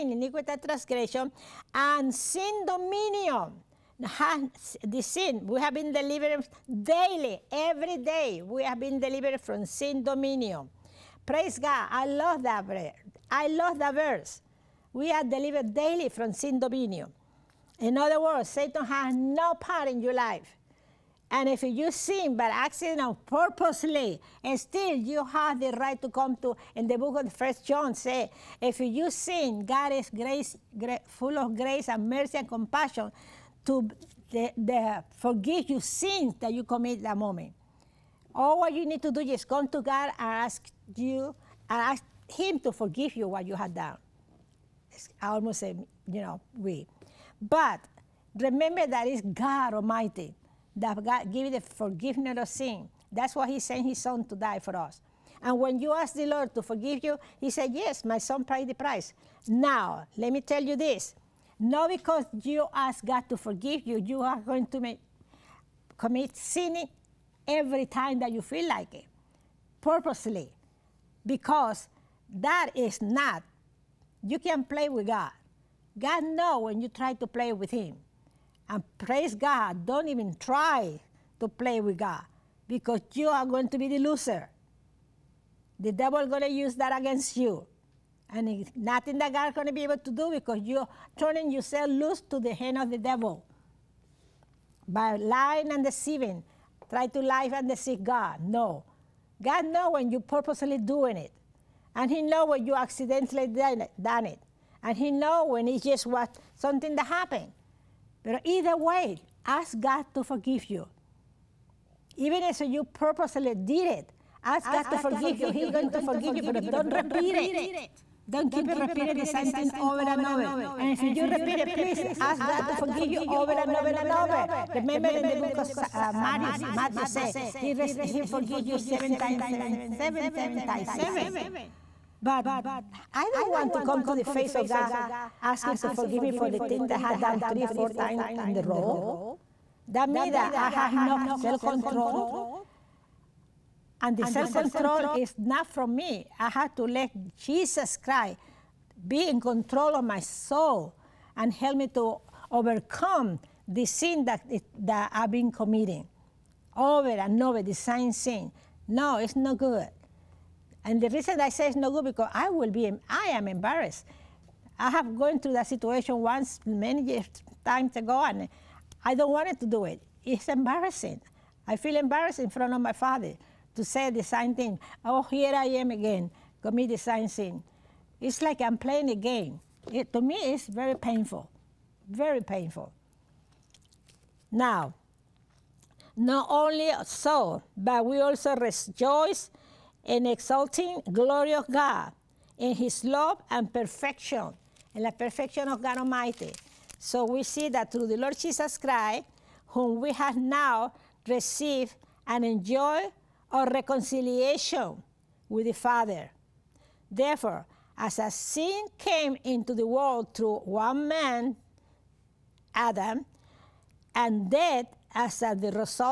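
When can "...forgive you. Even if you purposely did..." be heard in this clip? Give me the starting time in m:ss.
1:50.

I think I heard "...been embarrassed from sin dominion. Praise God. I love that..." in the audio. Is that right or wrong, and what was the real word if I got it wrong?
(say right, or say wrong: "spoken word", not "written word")
wrong: "delivered", not "embarrassed".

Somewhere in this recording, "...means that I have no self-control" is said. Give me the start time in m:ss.
2:20.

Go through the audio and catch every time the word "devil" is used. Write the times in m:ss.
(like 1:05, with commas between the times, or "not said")
1:25, 1:32.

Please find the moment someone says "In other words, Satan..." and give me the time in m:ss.
0:17.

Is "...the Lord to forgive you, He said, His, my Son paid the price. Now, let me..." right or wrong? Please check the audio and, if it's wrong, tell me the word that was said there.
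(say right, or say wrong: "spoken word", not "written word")
wrong: "Yes", not "His".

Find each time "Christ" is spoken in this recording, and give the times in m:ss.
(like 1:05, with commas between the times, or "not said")
2:27, 3:18.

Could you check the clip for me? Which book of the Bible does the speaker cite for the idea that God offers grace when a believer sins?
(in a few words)
First John.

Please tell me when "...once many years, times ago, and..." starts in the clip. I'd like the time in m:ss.
2:46.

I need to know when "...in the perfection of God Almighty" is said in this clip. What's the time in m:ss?
3:14.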